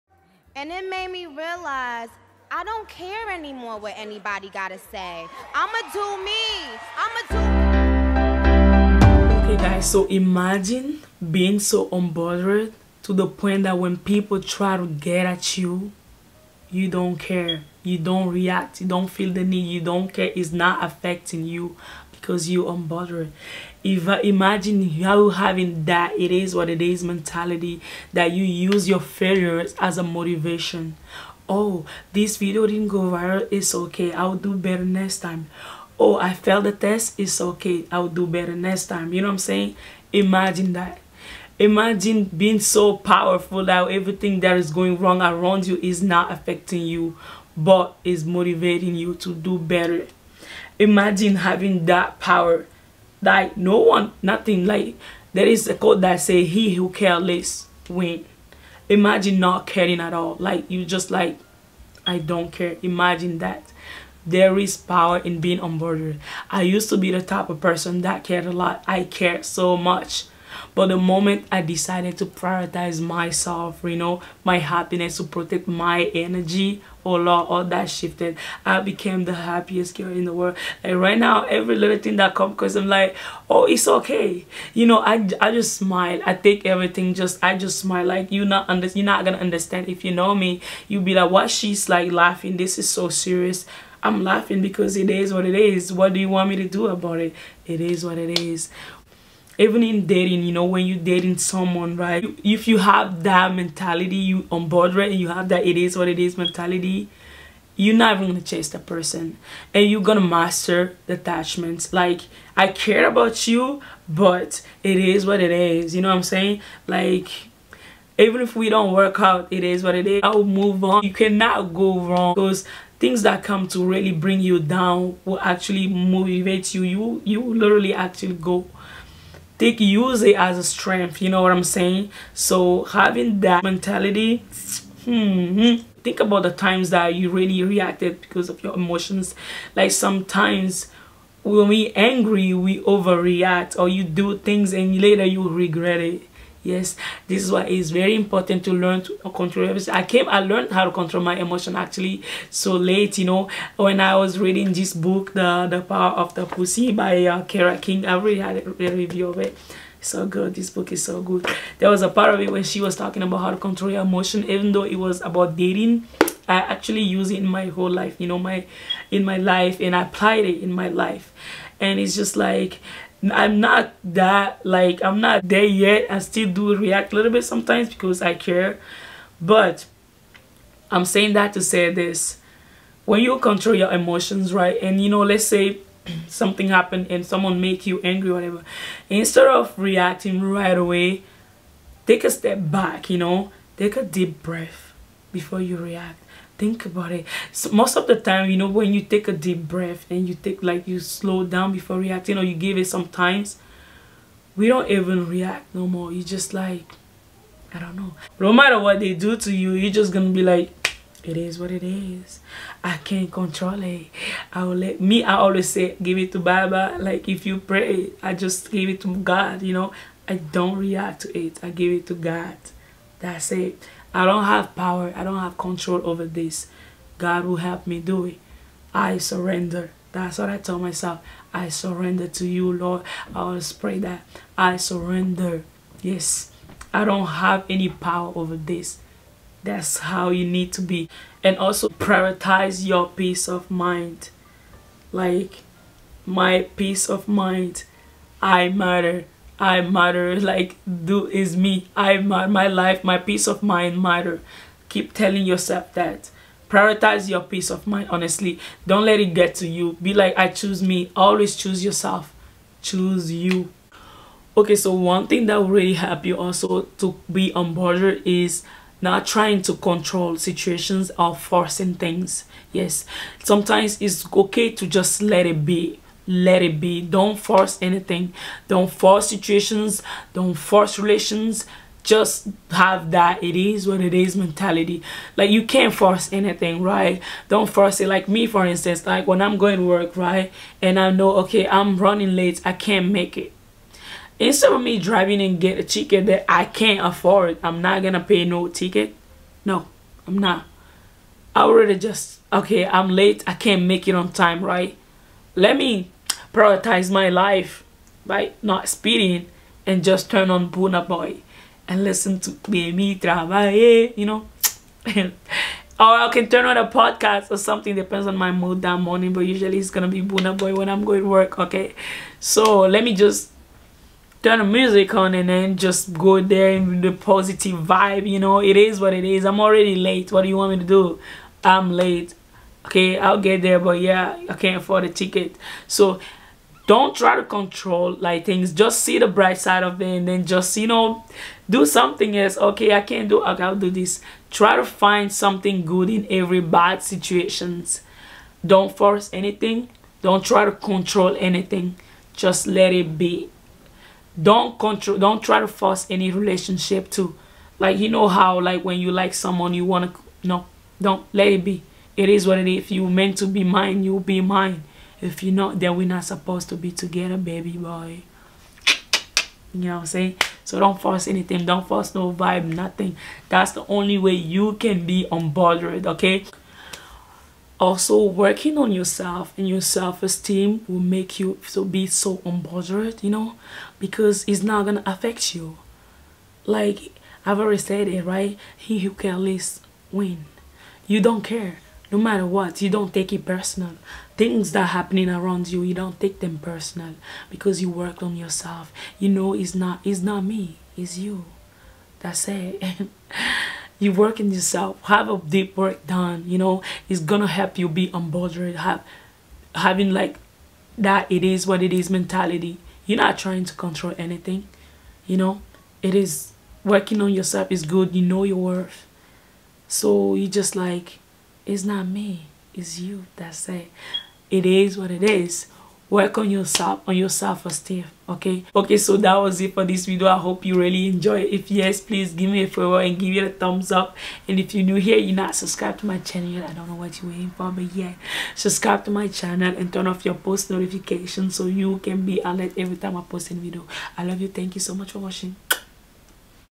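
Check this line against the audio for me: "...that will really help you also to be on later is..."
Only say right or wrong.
wrong.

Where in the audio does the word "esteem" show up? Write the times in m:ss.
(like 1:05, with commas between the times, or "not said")
6:19, 7:07.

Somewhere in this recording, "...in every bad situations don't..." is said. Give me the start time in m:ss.
5:46.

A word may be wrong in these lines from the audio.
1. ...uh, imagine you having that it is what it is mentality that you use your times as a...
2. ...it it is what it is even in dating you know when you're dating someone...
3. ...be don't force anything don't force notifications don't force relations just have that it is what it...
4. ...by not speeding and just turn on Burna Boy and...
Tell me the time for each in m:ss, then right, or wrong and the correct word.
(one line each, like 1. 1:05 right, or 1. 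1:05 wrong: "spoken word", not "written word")
1. 0:24 wrong: "failures", not "times"
2. 1:37 right
3. 4:36 wrong: "situations", not "notifications"
4. 5:08 right.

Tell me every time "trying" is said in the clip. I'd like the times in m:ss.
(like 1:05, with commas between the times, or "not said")
4:29, 6:53.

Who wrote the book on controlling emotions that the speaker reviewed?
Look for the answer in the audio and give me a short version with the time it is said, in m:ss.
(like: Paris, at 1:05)
Kara King, at 2:37.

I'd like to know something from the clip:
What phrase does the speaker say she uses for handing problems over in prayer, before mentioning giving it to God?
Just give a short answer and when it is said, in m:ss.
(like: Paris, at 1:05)
give it to baba, at 3:36.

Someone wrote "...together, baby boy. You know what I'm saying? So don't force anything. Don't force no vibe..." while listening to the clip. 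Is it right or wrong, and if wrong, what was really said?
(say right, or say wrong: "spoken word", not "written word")
right.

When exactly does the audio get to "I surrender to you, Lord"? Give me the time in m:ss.
3:51.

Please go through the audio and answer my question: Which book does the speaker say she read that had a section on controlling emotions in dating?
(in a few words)
The Power of the Pussy.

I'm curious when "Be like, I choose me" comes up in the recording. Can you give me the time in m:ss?
4:20.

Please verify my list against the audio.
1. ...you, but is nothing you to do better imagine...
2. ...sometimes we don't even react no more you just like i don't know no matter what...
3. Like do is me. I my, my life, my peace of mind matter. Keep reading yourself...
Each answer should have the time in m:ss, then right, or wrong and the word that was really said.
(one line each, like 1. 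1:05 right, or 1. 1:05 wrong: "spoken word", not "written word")
1. 0:46 wrong: "motivating", not "nothing"
2. 3:22 right
3. 4:10 wrong: "telling", not "reading".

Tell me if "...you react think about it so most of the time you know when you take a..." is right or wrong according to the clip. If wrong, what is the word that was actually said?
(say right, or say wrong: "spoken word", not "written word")
right.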